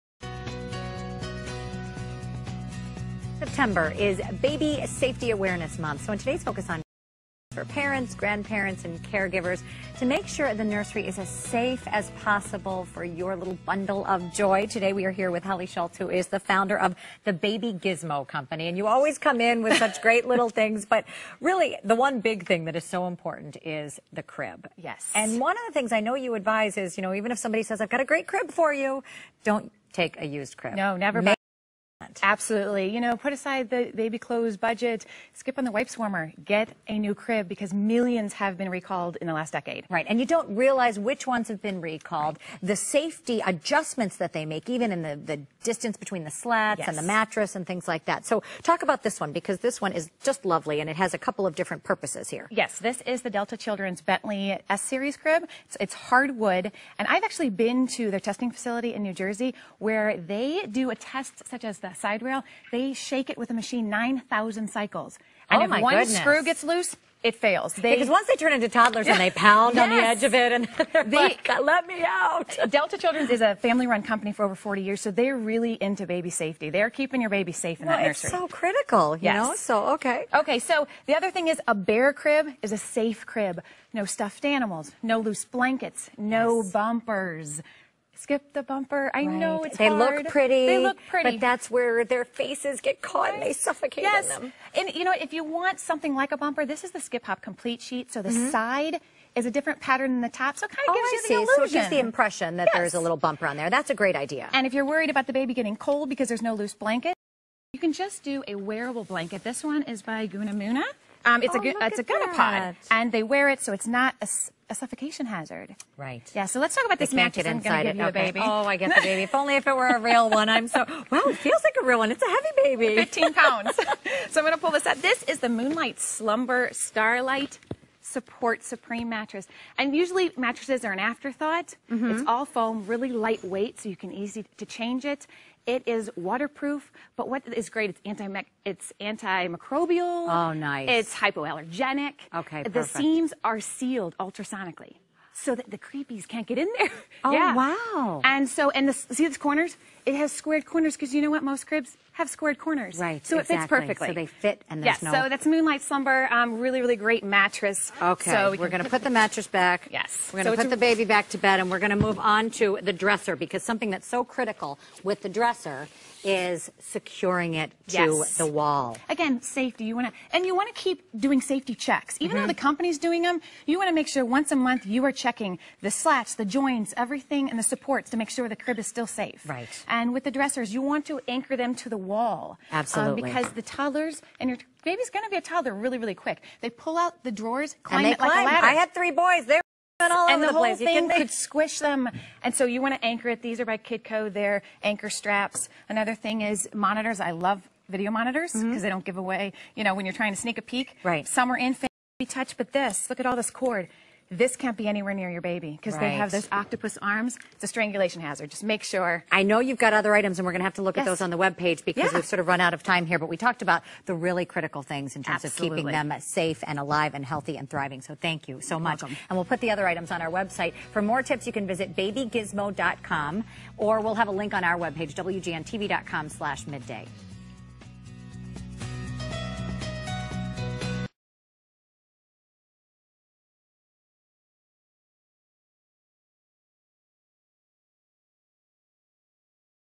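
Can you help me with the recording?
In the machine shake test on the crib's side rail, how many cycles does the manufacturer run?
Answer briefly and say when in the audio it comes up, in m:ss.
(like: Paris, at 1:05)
9,000, at 1:03.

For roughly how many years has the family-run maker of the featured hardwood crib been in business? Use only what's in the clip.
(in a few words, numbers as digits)
Over 40 years.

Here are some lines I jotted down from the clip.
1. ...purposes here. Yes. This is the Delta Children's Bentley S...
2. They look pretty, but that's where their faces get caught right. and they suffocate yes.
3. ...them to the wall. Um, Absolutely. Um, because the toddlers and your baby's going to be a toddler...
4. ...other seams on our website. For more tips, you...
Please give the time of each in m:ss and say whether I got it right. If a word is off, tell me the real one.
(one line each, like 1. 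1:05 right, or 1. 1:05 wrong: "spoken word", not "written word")
1. 0:51 right
2. 1:30 right
3. 3:01 right
4. 3:39 wrong: "items", not "seams".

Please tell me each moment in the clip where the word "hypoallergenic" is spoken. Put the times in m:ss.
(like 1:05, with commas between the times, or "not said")
2:21.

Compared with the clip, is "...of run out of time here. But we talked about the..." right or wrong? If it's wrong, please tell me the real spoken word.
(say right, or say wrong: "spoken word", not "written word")
right.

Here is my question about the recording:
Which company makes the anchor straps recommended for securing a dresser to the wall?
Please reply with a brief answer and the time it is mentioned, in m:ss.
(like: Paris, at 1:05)
Kidco, at 3:13.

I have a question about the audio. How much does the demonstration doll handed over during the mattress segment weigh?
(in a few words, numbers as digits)
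15 pounds.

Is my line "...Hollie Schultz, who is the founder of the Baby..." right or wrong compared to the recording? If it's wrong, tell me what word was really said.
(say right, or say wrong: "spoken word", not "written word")
right.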